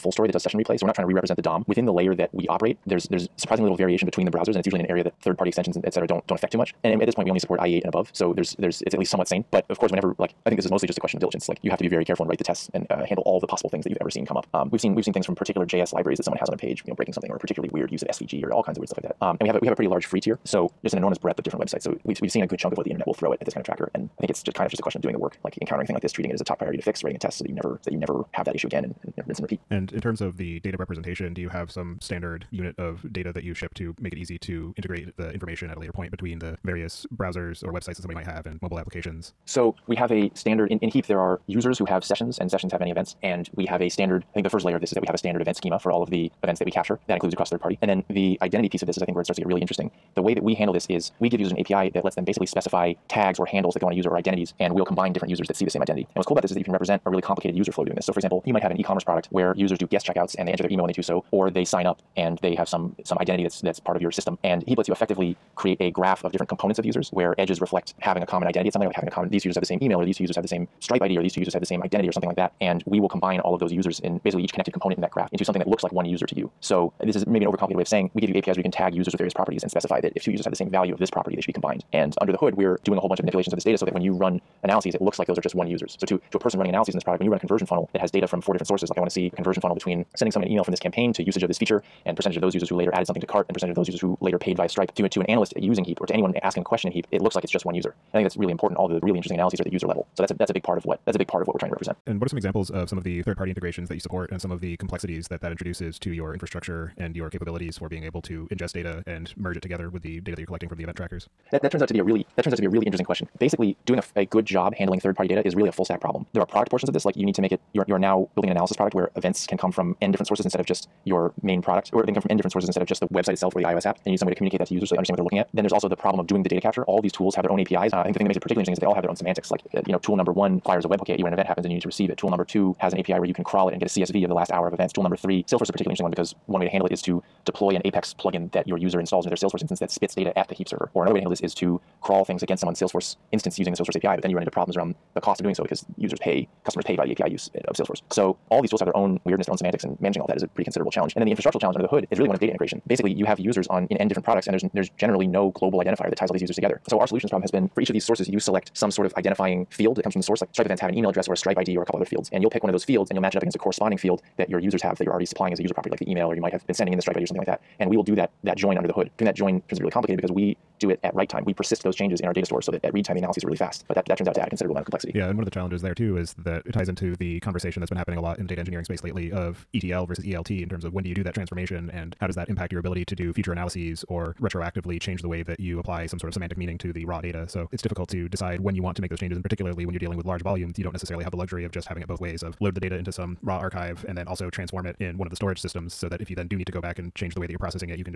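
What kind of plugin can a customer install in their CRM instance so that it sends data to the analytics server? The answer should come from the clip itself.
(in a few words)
Apex plugin.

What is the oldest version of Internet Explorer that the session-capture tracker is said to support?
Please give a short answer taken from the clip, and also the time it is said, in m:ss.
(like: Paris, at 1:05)
IE8, at 0:07.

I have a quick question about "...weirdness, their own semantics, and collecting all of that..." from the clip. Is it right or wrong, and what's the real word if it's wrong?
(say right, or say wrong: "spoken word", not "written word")
wrong: "managing", not "collecting".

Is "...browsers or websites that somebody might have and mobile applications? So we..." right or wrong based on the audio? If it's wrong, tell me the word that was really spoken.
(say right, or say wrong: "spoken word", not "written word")
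right.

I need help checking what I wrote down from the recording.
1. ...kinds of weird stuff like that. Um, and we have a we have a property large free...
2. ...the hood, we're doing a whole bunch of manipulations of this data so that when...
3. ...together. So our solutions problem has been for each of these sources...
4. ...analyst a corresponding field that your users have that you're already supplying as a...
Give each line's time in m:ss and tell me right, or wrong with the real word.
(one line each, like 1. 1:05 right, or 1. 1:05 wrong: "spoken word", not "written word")
1. 0:18 wrong: "pretty", not "property"
2. 1:22 right
3. 2:36 right
4. 2:43 wrong: "against", not "analyst".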